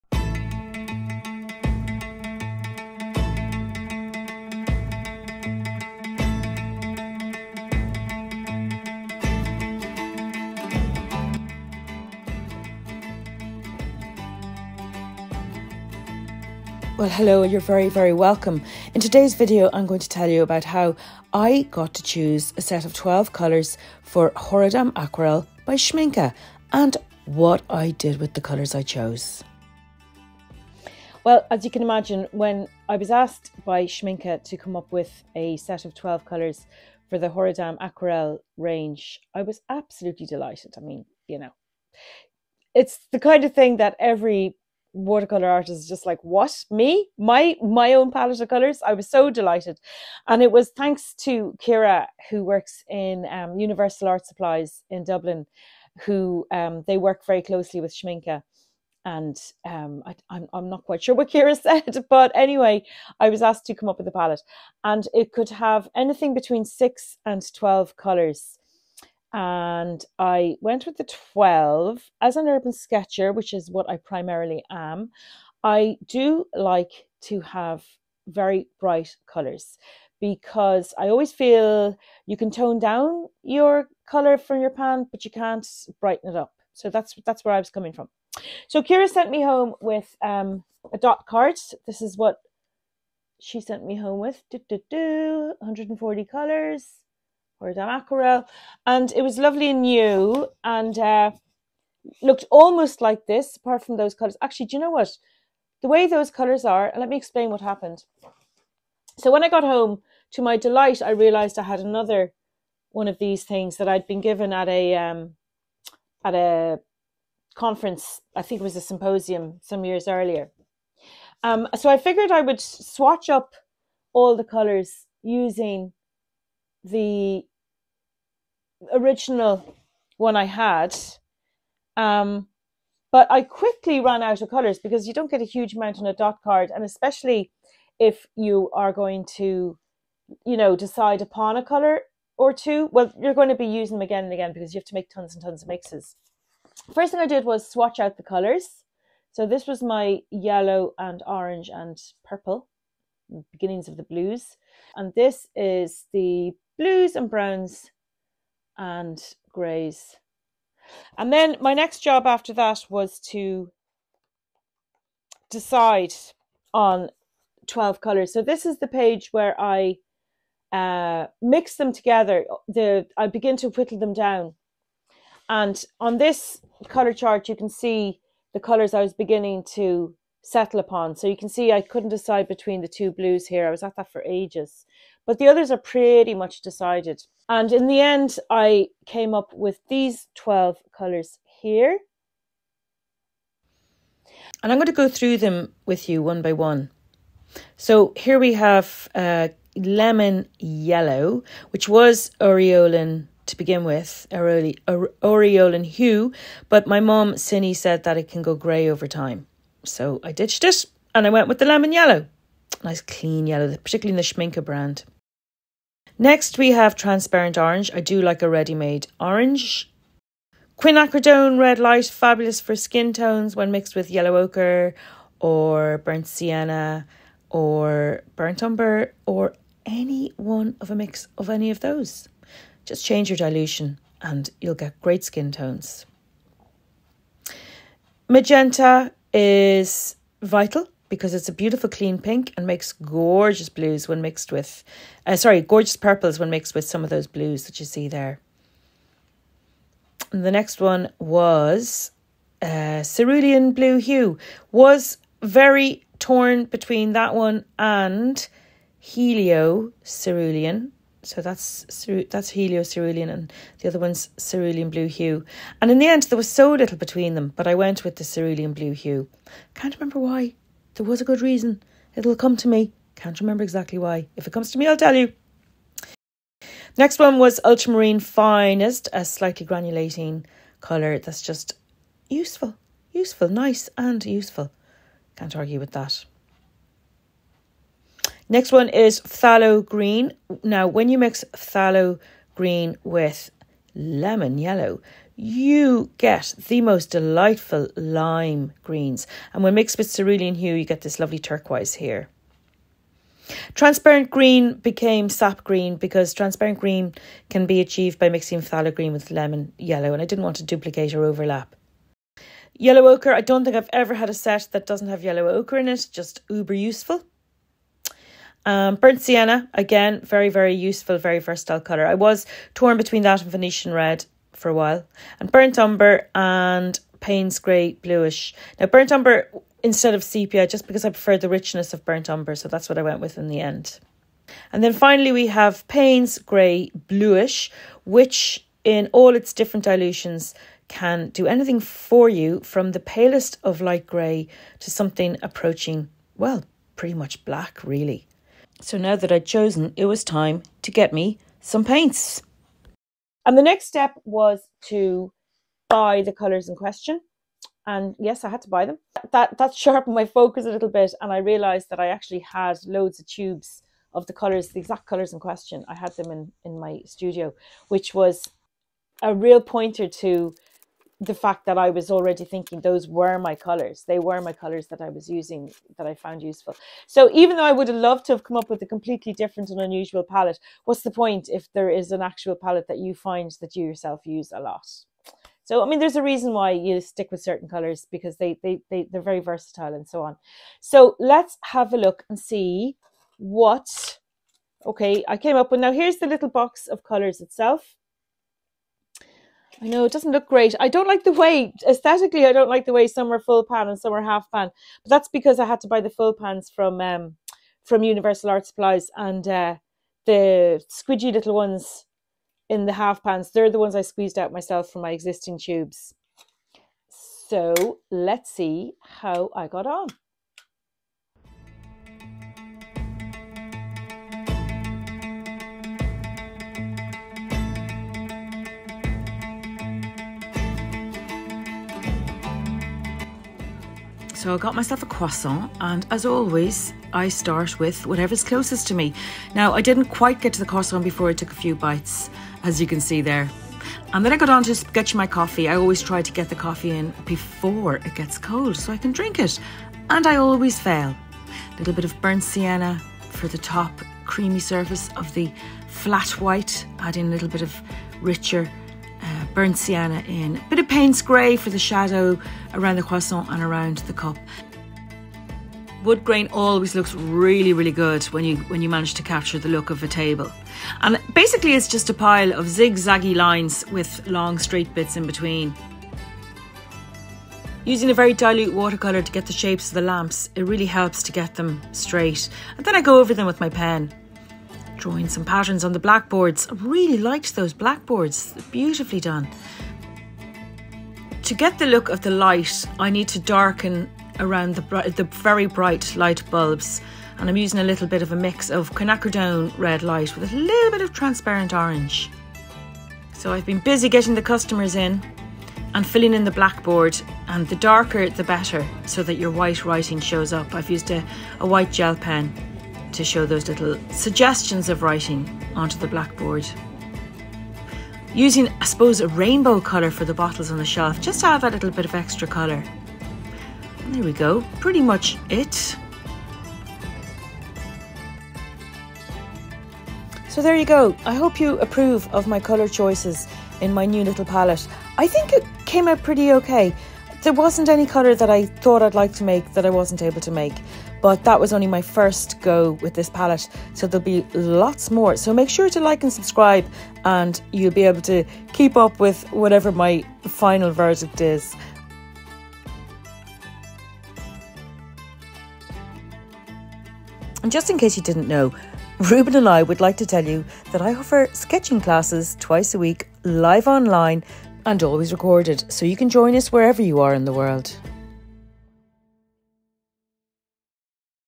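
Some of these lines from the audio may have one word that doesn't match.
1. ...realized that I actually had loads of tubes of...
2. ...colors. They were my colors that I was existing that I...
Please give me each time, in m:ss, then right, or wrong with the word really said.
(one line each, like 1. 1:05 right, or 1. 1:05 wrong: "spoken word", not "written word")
1. 6:01 right
2. 6:13 wrong: "using", not "existing".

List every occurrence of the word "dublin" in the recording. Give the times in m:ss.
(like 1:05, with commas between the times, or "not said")
0:55.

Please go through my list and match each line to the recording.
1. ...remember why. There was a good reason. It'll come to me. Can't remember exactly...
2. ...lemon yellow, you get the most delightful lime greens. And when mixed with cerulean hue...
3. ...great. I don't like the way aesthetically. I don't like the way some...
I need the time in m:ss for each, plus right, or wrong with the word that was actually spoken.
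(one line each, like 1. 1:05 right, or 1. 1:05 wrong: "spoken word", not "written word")
1. 4:29 right
2. 4:53 right
3. 6:40 right.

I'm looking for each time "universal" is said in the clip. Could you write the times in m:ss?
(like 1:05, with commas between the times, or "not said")
0:53, 6:48.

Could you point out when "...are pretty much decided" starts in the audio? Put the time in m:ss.
3:05.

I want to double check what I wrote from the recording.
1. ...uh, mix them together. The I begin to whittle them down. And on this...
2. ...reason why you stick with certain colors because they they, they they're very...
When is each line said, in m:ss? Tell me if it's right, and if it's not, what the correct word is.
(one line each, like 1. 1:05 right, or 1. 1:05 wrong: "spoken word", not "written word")
1. 2:50 right
2. 6:26 right.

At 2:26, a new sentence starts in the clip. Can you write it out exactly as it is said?
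First thing I did was swatch out the colors.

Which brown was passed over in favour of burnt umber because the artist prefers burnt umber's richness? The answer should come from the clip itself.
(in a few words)
Sepia.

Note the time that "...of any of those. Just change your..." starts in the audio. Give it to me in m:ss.
3:51.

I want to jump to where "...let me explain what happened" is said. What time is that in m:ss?
1:46.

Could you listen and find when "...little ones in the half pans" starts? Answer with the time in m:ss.
6:51.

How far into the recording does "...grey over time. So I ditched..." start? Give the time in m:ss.
3:28.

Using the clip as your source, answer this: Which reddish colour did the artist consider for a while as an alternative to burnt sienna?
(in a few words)
Venetian red.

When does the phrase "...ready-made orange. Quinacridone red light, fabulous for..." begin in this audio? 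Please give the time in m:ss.
3:38.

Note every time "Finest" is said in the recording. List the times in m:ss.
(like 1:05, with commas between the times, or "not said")
4:38.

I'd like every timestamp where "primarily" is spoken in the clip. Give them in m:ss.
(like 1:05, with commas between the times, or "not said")
1:13.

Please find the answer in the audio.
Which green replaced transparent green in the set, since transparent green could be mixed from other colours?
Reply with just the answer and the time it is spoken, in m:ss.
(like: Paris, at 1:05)
Sap green, at 5:05.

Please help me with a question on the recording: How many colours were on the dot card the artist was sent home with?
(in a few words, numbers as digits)
140.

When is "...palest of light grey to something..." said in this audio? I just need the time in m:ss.
5:42.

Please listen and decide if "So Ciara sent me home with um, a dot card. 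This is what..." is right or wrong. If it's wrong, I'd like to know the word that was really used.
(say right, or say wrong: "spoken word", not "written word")
right.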